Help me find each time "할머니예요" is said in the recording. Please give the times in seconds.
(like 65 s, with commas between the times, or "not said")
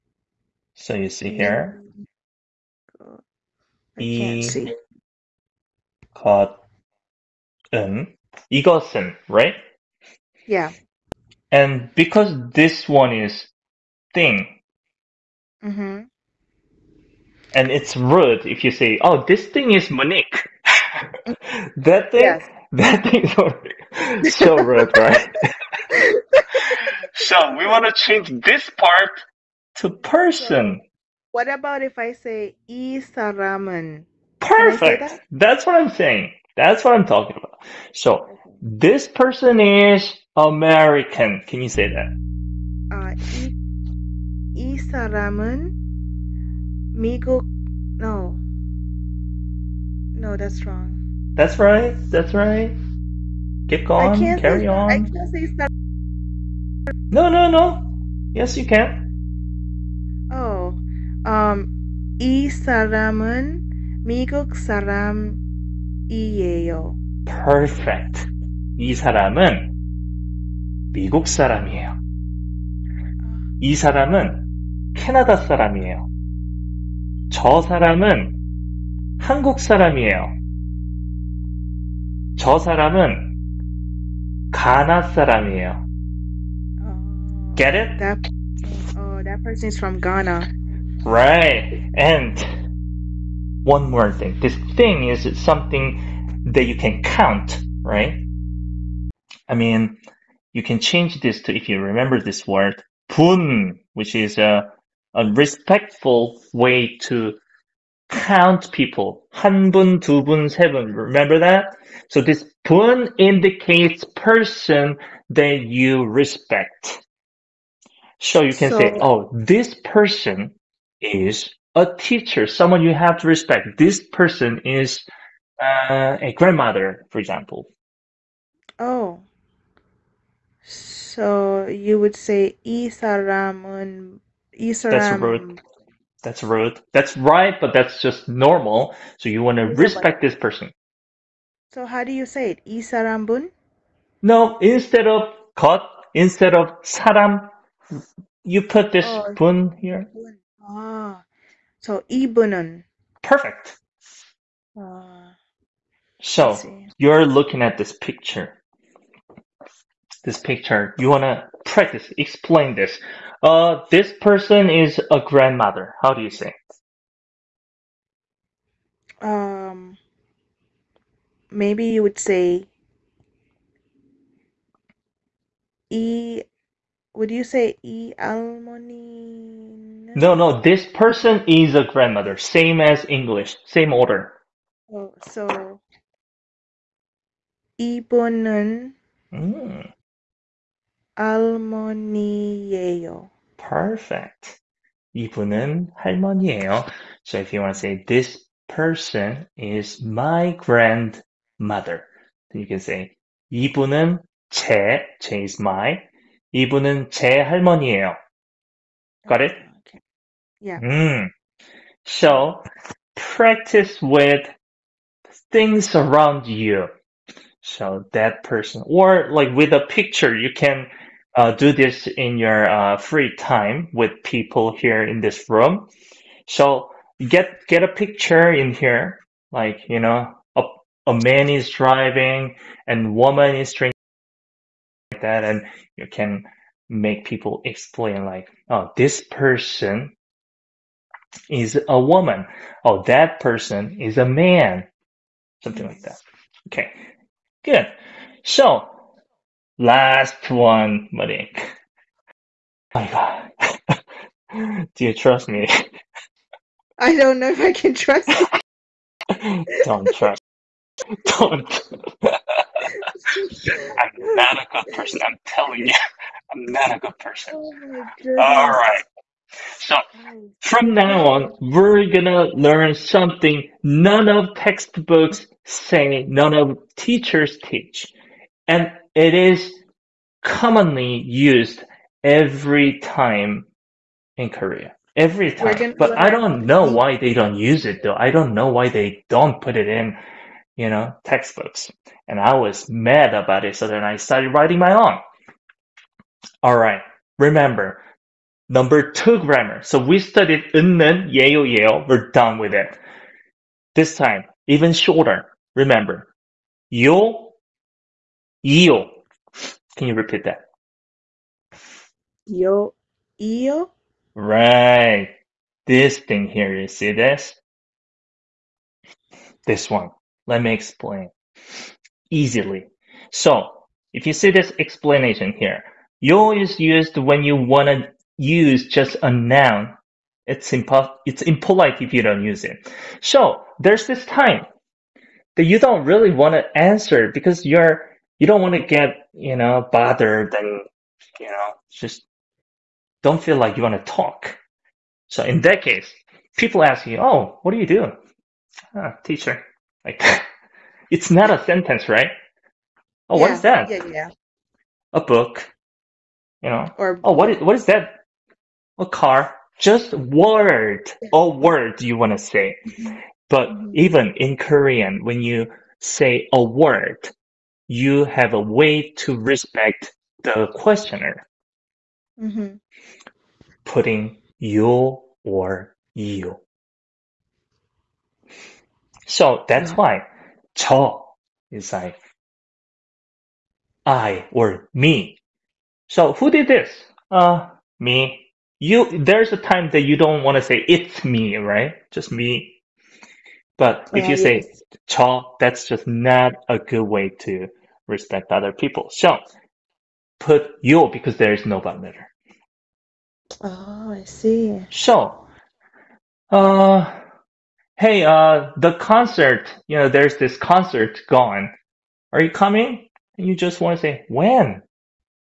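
191 s, 195 s, 207 s.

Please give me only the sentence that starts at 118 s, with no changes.
So you can so, say, oh, this person is a teacher, someone you have to respect.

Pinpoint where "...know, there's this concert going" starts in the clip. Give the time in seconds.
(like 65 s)
409 s.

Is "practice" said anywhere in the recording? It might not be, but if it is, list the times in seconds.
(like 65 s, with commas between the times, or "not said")
161 s, 213 s.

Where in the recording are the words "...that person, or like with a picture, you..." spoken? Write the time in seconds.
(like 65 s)
218 s.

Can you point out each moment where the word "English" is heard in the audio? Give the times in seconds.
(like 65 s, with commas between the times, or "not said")
183 s.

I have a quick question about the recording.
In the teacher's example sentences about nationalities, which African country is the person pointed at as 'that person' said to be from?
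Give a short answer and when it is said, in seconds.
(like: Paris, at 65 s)
Ghana, at 84 s.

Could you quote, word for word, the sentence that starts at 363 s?
even in korean when you say a word you have a way to respect the questioner.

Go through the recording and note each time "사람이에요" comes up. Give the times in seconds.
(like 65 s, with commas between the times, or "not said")
64 s, 71 s, 75 s, 79 s, 85 s.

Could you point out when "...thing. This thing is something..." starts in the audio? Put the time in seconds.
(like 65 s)
94 s.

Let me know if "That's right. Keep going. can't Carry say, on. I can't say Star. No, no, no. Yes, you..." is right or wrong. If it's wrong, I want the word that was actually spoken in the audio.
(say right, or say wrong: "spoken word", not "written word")
right.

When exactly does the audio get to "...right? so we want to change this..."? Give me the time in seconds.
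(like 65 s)
24 s.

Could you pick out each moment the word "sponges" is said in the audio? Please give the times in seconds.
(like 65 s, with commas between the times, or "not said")
not said.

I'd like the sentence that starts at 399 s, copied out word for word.
So put you because there is no bottom Oh, I see.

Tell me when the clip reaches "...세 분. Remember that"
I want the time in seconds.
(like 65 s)
110 s.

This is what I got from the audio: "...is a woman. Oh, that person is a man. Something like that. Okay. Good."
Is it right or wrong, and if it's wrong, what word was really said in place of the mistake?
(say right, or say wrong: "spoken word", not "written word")
right.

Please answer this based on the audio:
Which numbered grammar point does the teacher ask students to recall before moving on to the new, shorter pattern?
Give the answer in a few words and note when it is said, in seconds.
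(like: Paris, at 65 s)
Number two, at 298 s.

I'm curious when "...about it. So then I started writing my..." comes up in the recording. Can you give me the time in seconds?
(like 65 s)
293 s.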